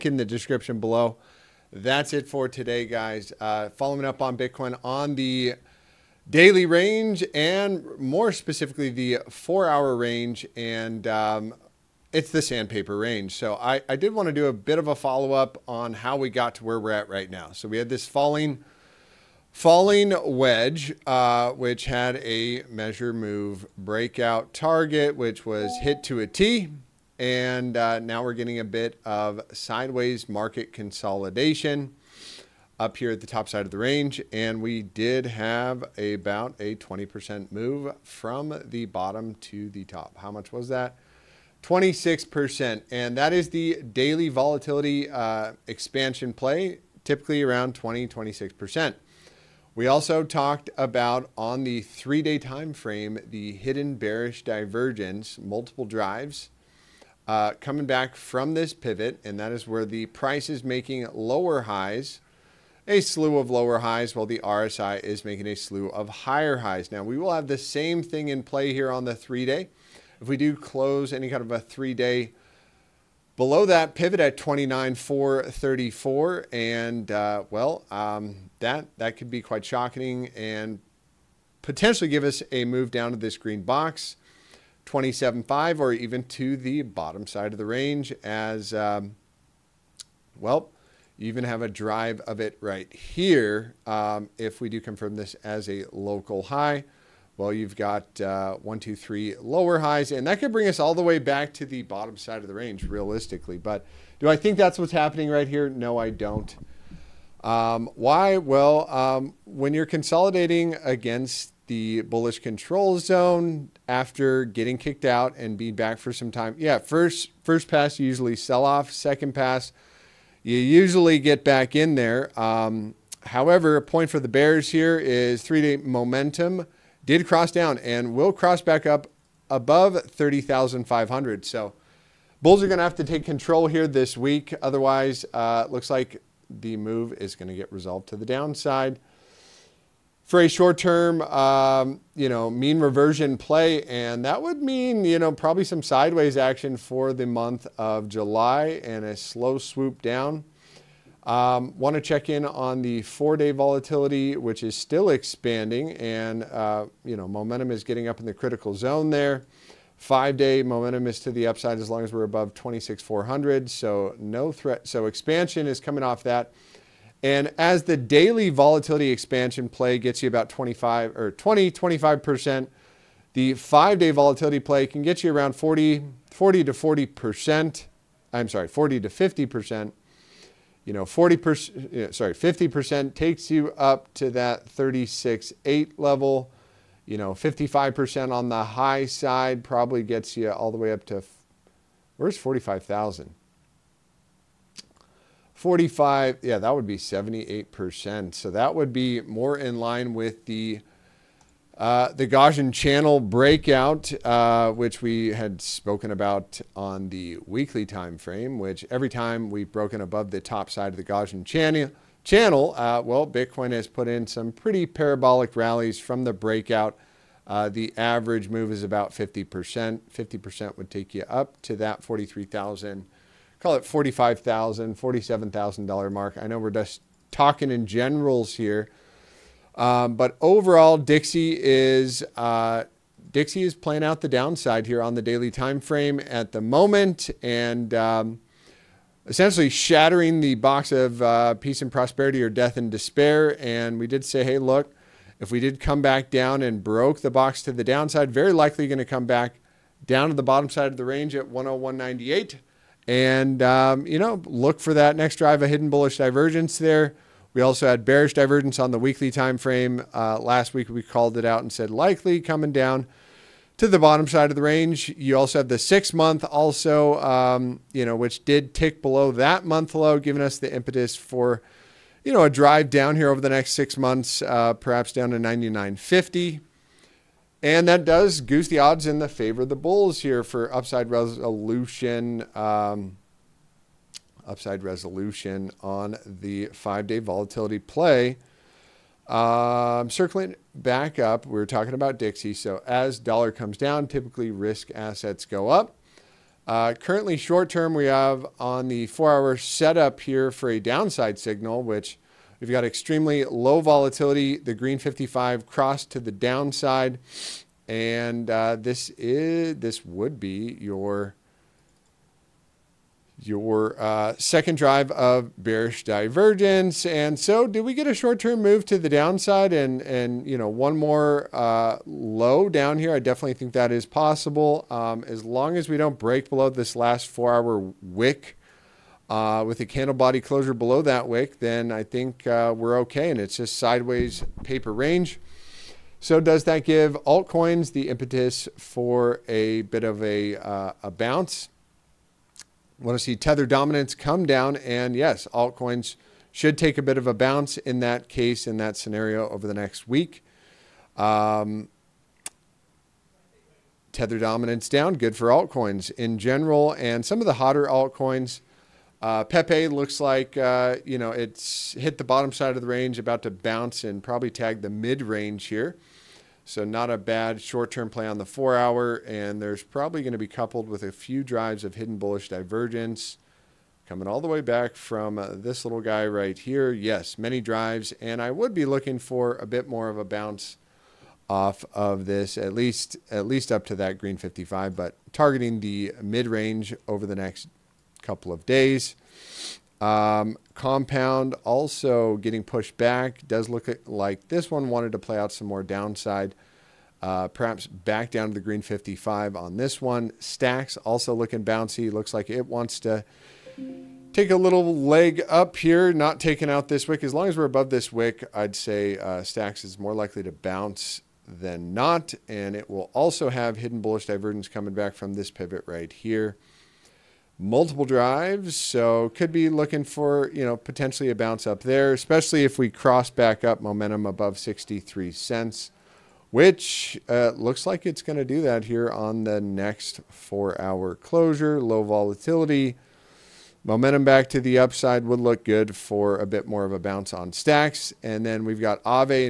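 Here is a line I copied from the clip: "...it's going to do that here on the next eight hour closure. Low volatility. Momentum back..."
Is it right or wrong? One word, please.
wrong.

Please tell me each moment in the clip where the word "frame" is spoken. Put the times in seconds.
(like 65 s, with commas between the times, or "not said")
52 s, 208 s, 235 s, 259 s.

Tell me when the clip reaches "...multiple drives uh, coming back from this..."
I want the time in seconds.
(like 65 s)
55 s.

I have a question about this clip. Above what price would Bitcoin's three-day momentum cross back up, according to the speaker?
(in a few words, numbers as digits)
30,500.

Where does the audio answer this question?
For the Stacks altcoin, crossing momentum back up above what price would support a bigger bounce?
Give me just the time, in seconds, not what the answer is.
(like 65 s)
424 s.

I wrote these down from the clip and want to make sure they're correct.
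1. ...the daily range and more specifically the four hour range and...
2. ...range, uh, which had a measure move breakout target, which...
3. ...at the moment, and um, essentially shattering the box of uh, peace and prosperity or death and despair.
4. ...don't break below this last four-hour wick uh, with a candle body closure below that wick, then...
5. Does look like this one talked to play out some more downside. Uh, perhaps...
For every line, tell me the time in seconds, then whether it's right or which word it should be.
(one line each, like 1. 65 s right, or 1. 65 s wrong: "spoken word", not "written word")
1. 5 s right
2. 20 s wrong: "wedge", not "range"
3. 236 s right
4. 325 s right
5. 393 s wrong: "wanted", not "talked".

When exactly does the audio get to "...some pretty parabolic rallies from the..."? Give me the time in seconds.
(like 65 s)
214 s.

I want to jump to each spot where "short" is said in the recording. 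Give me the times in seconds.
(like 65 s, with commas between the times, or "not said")
140 s, 297 s, 318 s, 367 s.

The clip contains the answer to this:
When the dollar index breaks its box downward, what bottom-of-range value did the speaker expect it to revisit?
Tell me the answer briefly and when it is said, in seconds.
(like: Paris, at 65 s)
101.98, at 251 s.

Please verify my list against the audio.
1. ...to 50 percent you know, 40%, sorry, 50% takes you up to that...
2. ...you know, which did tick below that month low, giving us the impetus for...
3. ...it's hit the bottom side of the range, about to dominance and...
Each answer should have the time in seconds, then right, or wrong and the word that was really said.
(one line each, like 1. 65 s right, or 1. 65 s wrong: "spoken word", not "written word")
1. 179 s right
2. 267 s right
3. 361 s wrong: "bounce", not "dominance".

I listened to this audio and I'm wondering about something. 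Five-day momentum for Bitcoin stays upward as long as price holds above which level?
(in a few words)
26,400.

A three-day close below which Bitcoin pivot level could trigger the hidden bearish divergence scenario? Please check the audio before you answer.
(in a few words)
29,434.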